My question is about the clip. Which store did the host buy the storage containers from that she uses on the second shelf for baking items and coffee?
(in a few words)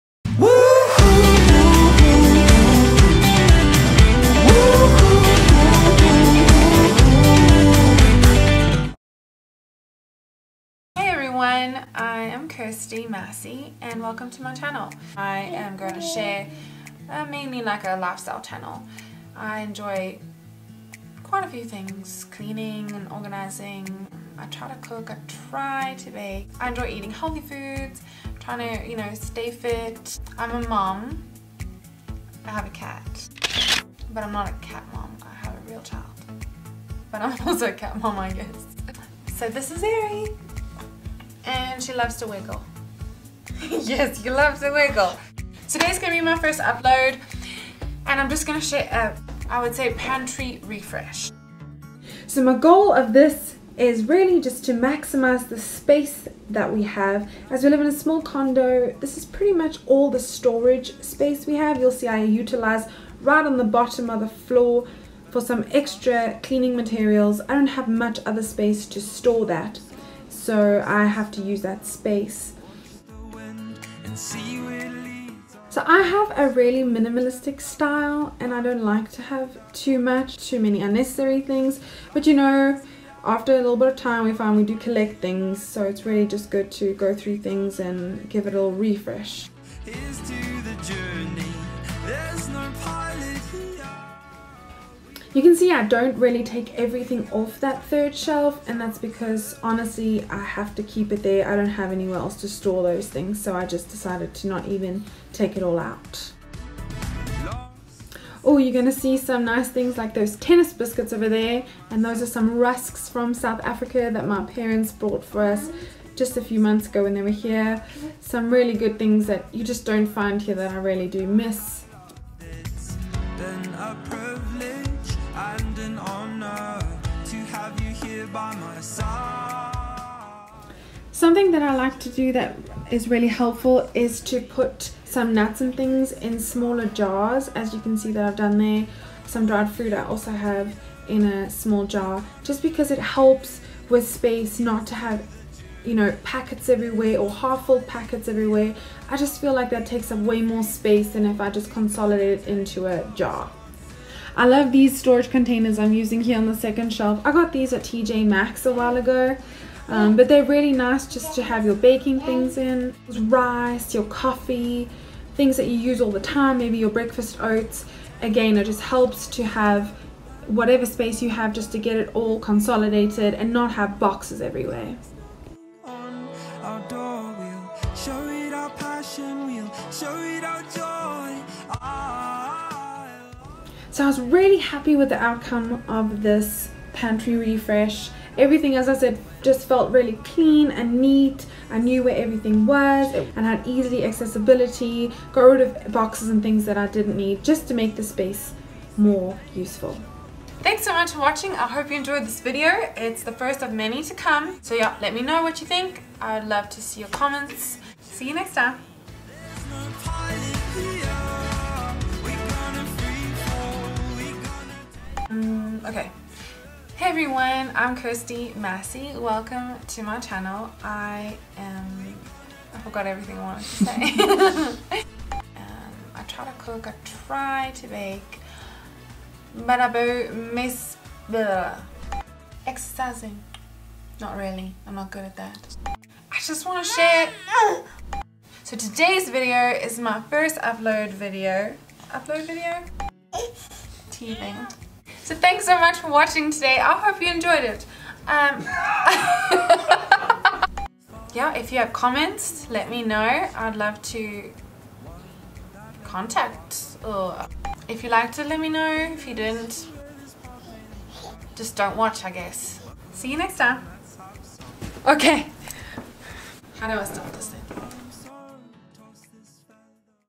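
TJ Maxx.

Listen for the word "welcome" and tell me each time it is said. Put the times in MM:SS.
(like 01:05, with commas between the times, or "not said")
00:13, 03:39.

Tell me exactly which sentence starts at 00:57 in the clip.
As we live in a small condo, this is pretty much all the storage space we have.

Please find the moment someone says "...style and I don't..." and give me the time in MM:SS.
01:17.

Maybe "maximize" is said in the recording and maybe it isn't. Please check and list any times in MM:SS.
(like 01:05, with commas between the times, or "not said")
00:54.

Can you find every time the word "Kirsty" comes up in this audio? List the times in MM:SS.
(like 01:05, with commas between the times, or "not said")
00:12, 03:37.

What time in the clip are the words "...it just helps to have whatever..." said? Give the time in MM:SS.
02:48.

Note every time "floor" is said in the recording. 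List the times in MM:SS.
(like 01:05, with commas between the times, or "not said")
01:04.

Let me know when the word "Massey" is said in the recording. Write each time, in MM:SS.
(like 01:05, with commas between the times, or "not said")
00:13, 03:38.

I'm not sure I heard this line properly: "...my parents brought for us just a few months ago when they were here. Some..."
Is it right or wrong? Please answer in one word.
right.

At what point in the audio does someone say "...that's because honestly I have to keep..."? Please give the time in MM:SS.
01:38.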